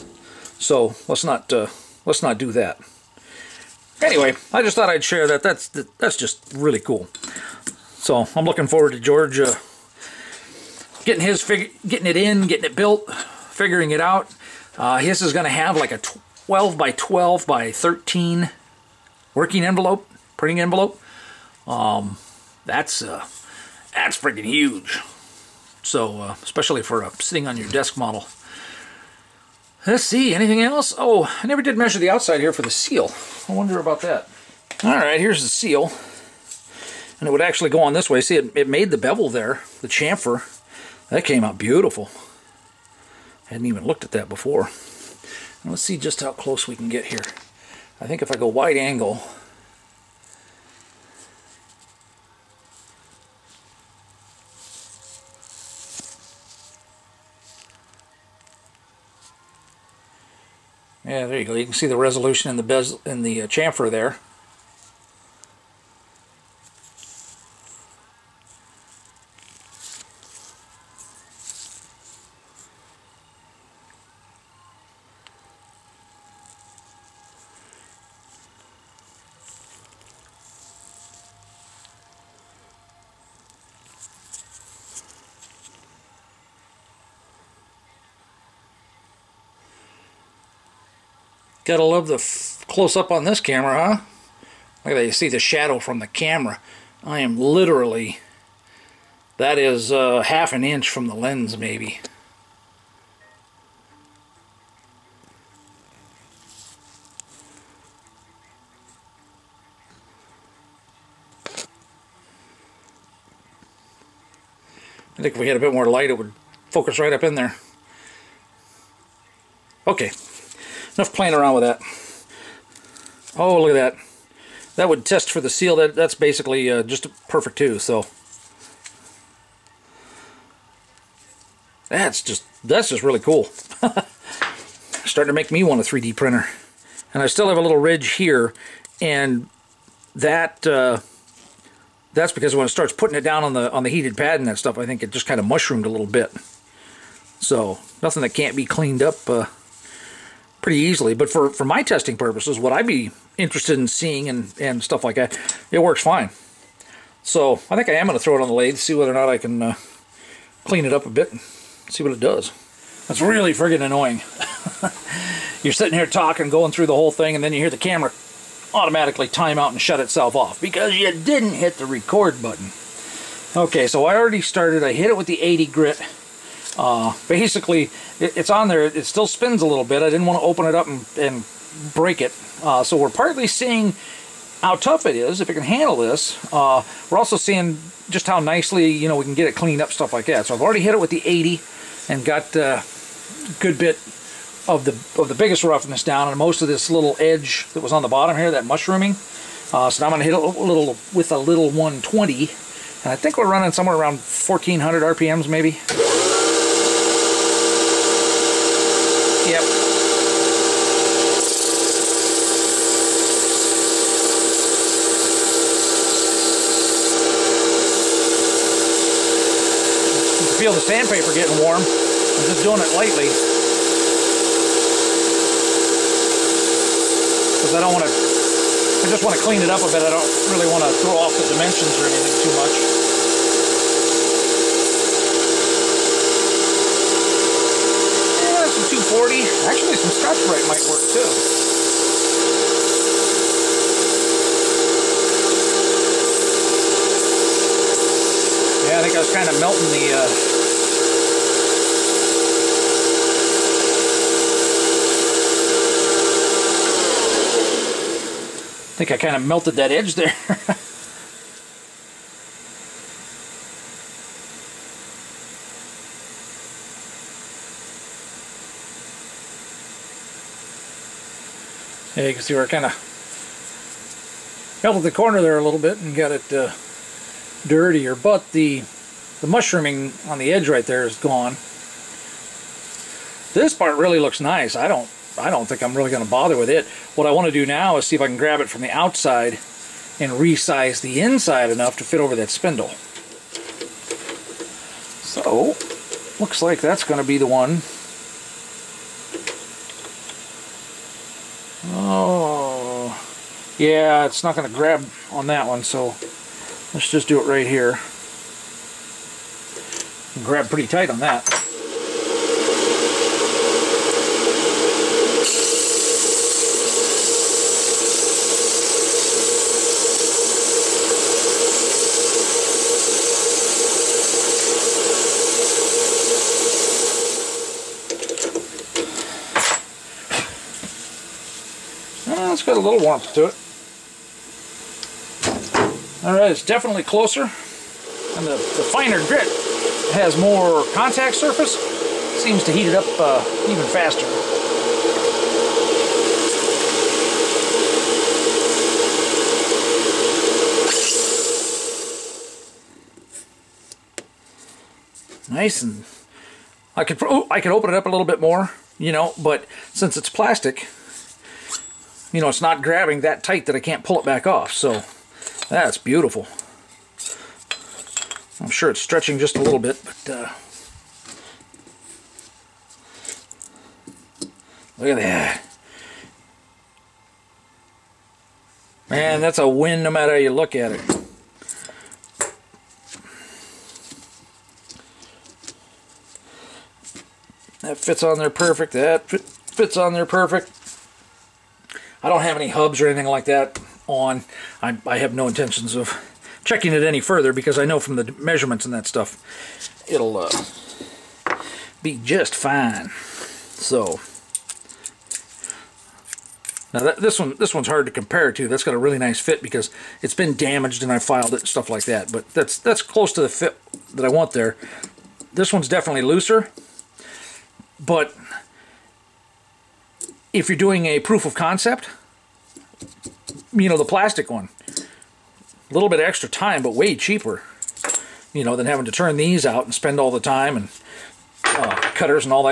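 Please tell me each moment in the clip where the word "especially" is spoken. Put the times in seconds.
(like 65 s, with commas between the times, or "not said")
26 s.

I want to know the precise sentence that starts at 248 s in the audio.
Yeah, I think I was kind of melting the uh, I think I kind of melted that edge there.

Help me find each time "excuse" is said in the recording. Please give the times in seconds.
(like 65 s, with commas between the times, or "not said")
not said.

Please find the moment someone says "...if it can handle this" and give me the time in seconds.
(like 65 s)
185 s.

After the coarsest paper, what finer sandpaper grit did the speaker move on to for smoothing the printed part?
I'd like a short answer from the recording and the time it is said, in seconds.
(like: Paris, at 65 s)
120, at 201 s.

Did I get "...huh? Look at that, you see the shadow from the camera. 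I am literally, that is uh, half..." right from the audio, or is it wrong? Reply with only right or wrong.
right.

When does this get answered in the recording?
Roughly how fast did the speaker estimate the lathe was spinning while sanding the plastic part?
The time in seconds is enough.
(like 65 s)
204 s.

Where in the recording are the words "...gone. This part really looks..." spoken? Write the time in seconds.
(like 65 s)
281 s.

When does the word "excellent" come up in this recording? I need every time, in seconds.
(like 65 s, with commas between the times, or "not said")
not said.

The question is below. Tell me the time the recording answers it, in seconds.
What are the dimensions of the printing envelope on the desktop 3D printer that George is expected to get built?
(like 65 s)
15 s.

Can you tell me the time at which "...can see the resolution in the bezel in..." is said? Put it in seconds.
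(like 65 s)
61 s.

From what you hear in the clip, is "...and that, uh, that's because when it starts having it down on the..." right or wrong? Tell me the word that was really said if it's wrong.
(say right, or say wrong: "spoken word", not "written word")
wrong: "putting", not "having".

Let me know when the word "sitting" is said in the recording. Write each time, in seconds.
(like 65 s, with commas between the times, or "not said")
27 s, 165 s.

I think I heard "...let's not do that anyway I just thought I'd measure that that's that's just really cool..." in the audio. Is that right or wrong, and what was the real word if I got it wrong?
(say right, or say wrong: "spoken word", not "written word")
wrong: "share", not "measure".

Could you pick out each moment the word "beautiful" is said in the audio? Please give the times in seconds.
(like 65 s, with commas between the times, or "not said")
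41 s, 365 s.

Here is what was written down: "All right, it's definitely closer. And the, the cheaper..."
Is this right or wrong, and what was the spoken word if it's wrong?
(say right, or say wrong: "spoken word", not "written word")
wrong: "finer", not "cheaper".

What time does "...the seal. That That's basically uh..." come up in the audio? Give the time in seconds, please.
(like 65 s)
125 s.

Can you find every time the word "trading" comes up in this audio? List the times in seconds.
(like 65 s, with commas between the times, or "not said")
not said.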